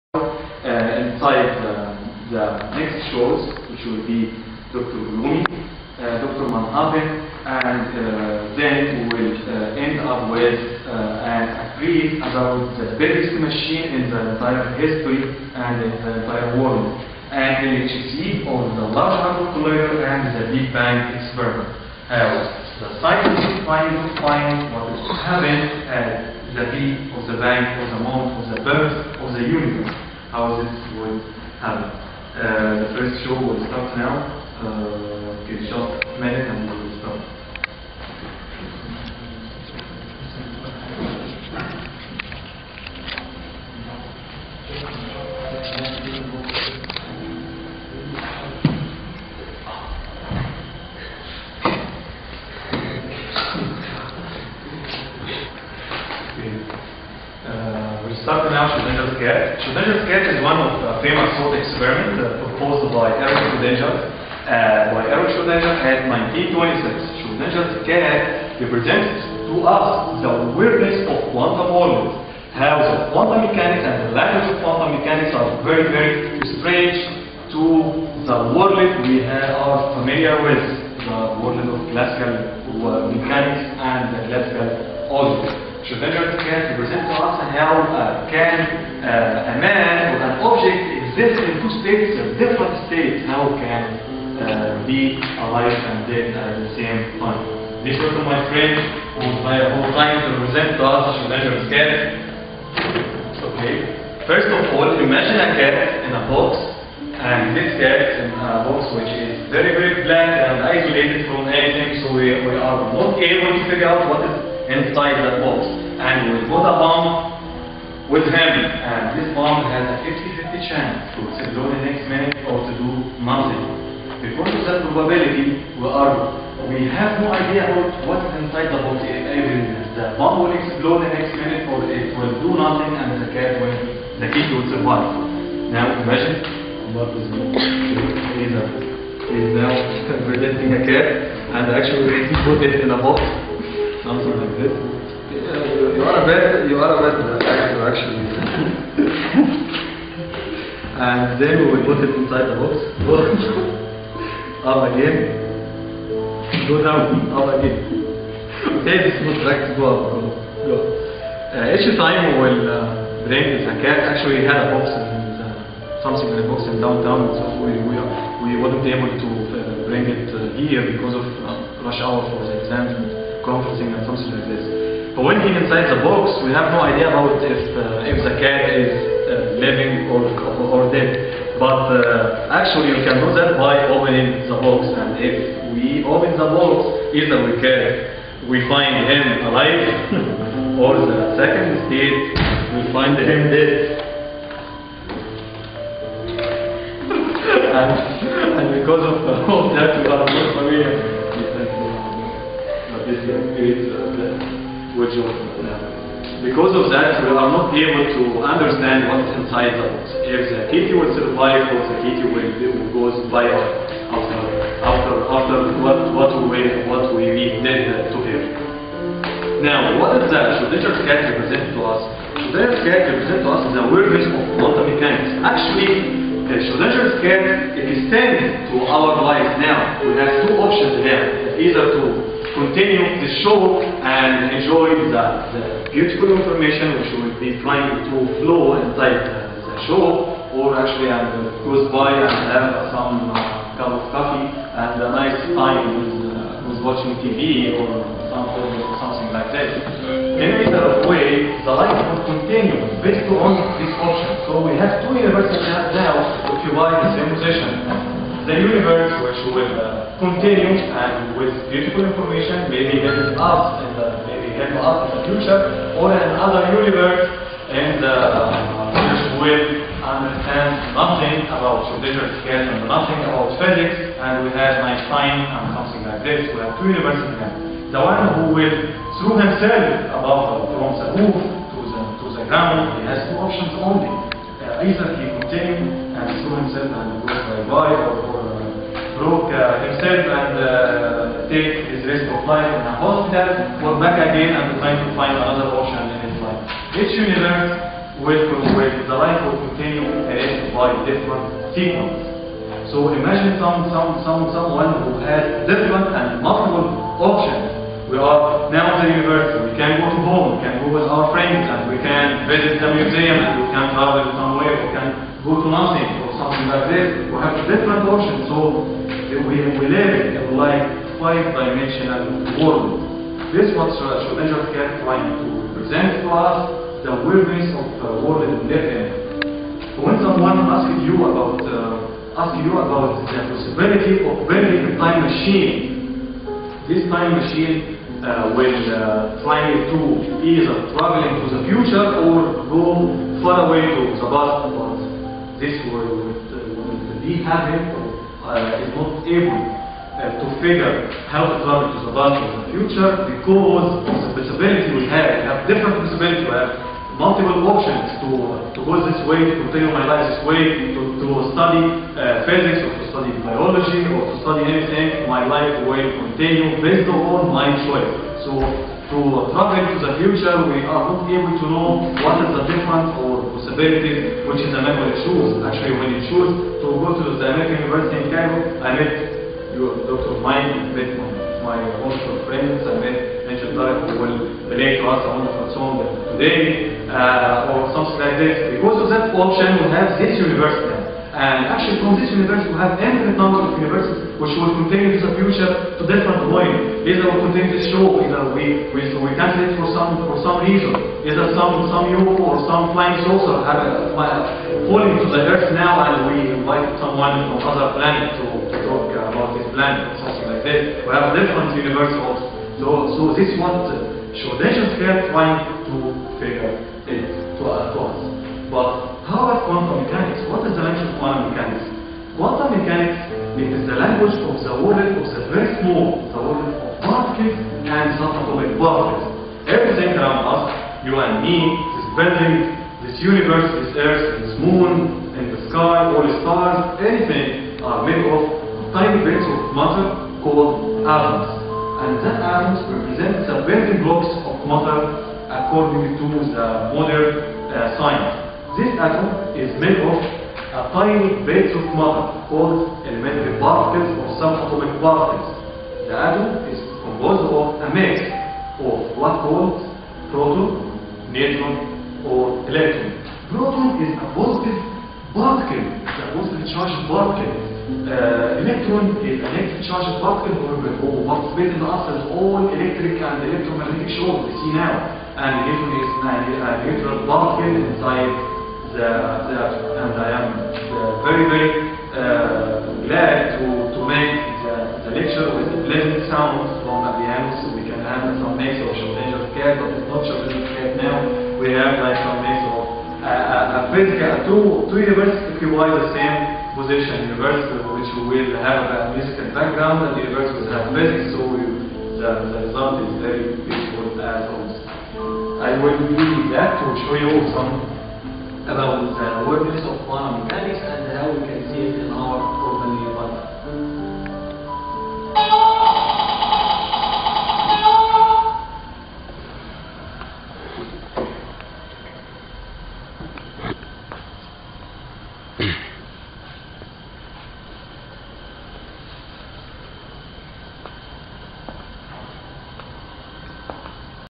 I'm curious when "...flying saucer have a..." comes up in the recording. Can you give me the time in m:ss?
6:42.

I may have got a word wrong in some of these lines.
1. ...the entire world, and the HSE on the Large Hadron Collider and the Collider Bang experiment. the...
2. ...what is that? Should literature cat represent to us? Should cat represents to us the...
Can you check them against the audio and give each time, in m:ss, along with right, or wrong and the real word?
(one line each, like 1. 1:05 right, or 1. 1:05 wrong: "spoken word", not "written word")
1. 0:16 wrong: "Big", not "Collider"
2. 3:40 right.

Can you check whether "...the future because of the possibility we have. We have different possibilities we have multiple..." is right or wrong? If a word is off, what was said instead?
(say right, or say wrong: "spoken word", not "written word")
right.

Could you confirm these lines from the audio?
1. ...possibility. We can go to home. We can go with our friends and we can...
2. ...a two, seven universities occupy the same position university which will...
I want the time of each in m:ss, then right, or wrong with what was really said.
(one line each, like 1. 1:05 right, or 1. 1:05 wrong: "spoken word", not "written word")
1. 5:09 wrong: "university", not "possibility"
2. 8:14 wrong: "two", not "seven".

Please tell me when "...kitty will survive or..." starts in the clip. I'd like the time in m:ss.
3:30.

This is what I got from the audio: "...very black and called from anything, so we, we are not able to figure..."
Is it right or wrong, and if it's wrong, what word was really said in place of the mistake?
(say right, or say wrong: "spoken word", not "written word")
wrong: "isolated", not "called".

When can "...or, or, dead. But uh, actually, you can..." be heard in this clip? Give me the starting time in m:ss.
3:00.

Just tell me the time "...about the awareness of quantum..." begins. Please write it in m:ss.
8:28.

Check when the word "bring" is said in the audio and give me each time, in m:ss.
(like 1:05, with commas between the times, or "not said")
2:43, 2:49.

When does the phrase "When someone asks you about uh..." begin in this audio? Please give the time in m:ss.
5:30.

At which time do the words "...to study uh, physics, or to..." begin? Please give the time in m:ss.
6:01.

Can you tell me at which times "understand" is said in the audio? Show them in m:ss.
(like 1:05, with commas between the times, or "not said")
3:28, 4:30.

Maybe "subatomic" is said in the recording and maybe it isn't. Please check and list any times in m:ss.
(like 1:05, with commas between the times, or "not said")
7:08, 7:34.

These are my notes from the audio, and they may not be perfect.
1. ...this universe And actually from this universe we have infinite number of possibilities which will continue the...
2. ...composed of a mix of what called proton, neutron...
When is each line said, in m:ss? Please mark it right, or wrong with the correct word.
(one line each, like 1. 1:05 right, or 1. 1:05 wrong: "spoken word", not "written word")
1. 6:30 wrong: "universes", not "possibilities"
2. 7:37 right.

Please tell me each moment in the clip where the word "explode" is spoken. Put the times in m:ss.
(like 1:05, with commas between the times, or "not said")
2:01, 2:10.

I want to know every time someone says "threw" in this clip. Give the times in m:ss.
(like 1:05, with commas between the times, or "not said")
4:46.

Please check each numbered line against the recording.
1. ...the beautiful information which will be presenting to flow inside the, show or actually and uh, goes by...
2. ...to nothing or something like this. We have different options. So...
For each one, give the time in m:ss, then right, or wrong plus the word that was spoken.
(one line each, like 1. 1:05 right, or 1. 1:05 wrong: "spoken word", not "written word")
1. 3:55 wrong: "trying", not "presenting"
2. 5:15 right.